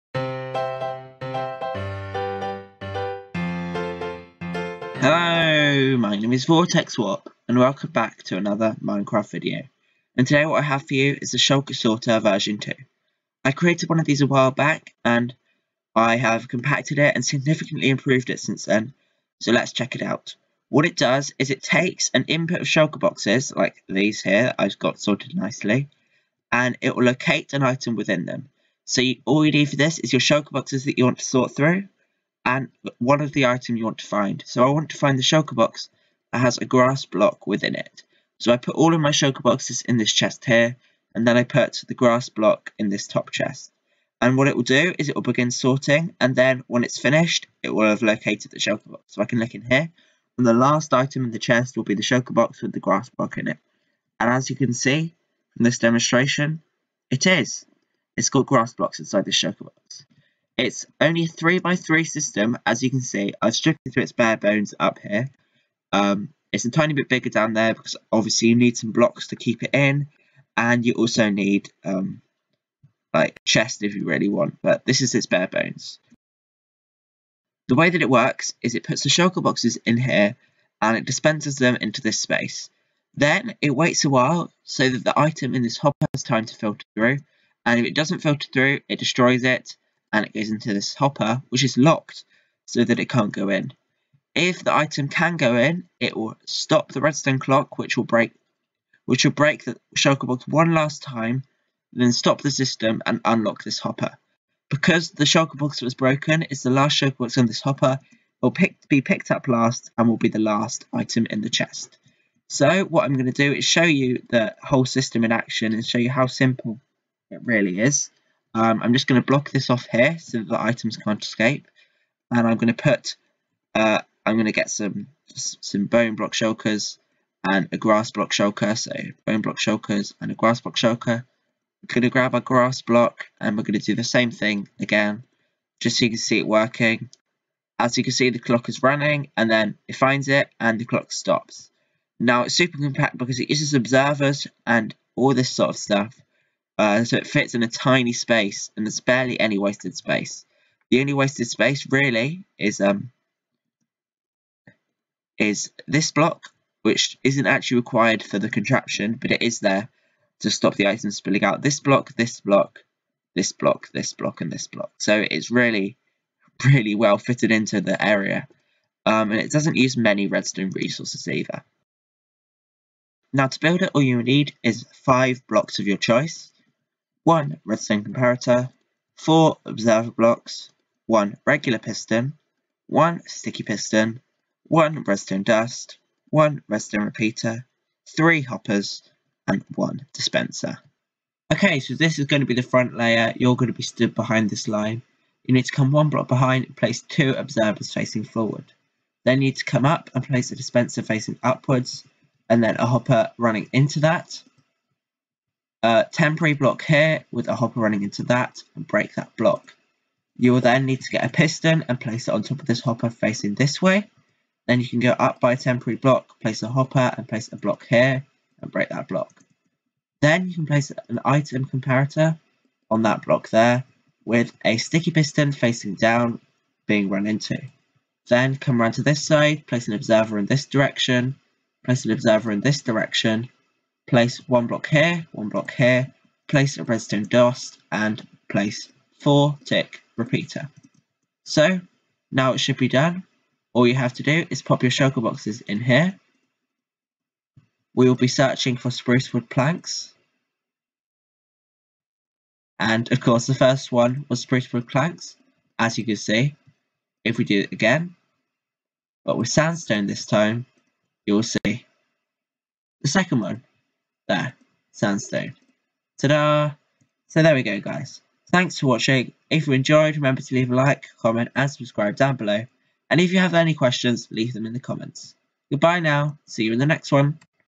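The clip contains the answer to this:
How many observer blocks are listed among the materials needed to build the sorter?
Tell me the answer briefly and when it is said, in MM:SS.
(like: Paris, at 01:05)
4, at 02:59.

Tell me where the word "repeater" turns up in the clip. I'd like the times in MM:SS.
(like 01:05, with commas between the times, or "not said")
03:07, 04:00.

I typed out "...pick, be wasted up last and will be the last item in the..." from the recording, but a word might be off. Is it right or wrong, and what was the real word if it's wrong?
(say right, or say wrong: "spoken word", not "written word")
wrong: "picked", not "wasted".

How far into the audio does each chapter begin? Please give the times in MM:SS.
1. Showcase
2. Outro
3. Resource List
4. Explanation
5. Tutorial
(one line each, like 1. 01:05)
1. 00:20
2. 04:28
3. 02:54
4. 01:17
5. 03:11.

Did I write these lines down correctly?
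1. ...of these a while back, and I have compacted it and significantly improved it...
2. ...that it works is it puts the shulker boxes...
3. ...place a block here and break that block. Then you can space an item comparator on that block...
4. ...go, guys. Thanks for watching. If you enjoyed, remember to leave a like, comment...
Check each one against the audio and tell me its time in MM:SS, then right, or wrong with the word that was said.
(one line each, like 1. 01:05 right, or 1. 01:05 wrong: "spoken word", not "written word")
1. 00:13 right
2. 01:17 right
3. 03:37 wrong: "place", not "space"
4. 04:27 right.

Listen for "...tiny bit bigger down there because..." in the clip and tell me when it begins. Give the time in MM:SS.
01:06.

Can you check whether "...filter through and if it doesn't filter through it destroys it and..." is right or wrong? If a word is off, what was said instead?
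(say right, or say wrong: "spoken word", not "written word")
right.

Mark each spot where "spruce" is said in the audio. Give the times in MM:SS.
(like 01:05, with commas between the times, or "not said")
04:08, 04:14.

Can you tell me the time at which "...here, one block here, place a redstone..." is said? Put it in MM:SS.
03:54.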